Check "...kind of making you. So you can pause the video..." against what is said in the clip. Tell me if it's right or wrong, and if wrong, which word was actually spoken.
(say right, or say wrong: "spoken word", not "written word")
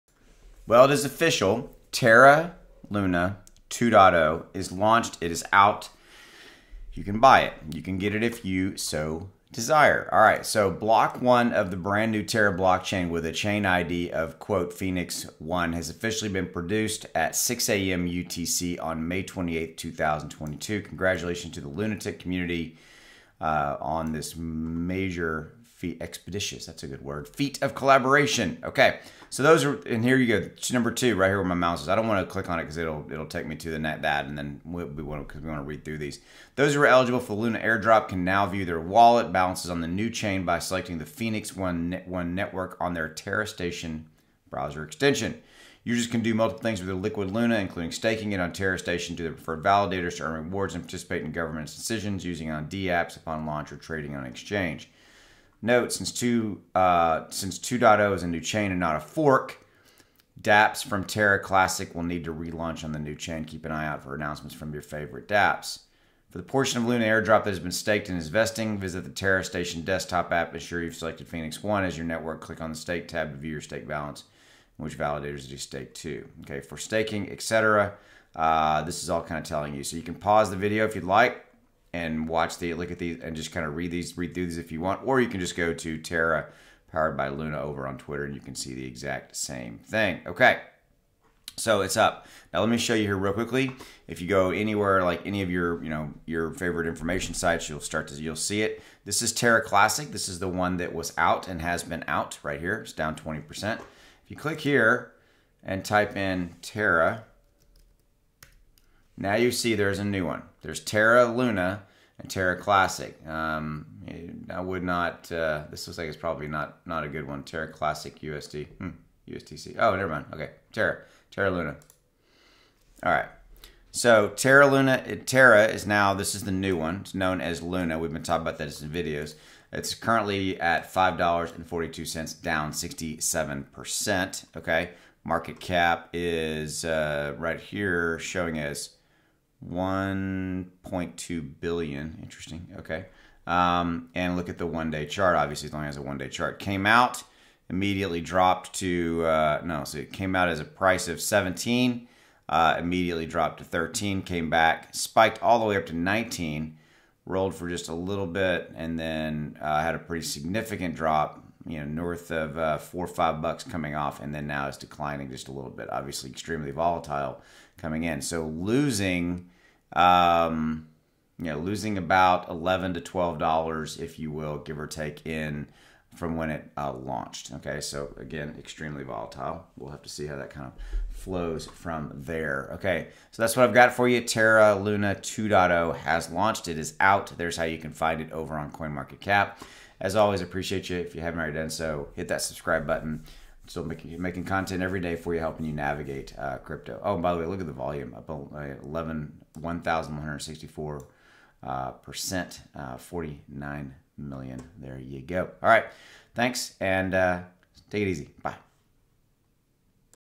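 wrong: "telling", not "making".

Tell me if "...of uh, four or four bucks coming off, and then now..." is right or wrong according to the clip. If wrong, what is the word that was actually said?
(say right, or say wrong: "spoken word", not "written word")
wrong: "five", not "four".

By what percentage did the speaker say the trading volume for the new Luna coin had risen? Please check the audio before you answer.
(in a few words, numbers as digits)
1,164 percent.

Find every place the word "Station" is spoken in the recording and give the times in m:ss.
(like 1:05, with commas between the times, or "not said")
0:43, 0:48, 1:09.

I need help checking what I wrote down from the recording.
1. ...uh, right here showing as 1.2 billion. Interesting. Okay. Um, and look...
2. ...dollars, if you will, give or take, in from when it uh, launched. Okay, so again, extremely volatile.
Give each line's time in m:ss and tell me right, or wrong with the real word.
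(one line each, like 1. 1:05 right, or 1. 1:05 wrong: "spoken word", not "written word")
1. 2:16 right
2. 2:53 right.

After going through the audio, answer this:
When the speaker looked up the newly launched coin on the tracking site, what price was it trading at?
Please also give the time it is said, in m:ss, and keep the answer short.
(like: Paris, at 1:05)
$5.42, at 2:10.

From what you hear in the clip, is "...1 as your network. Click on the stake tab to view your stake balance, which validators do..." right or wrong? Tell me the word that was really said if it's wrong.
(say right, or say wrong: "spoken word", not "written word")
right.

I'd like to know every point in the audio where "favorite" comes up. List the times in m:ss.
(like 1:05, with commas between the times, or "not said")
1:04, 1:36.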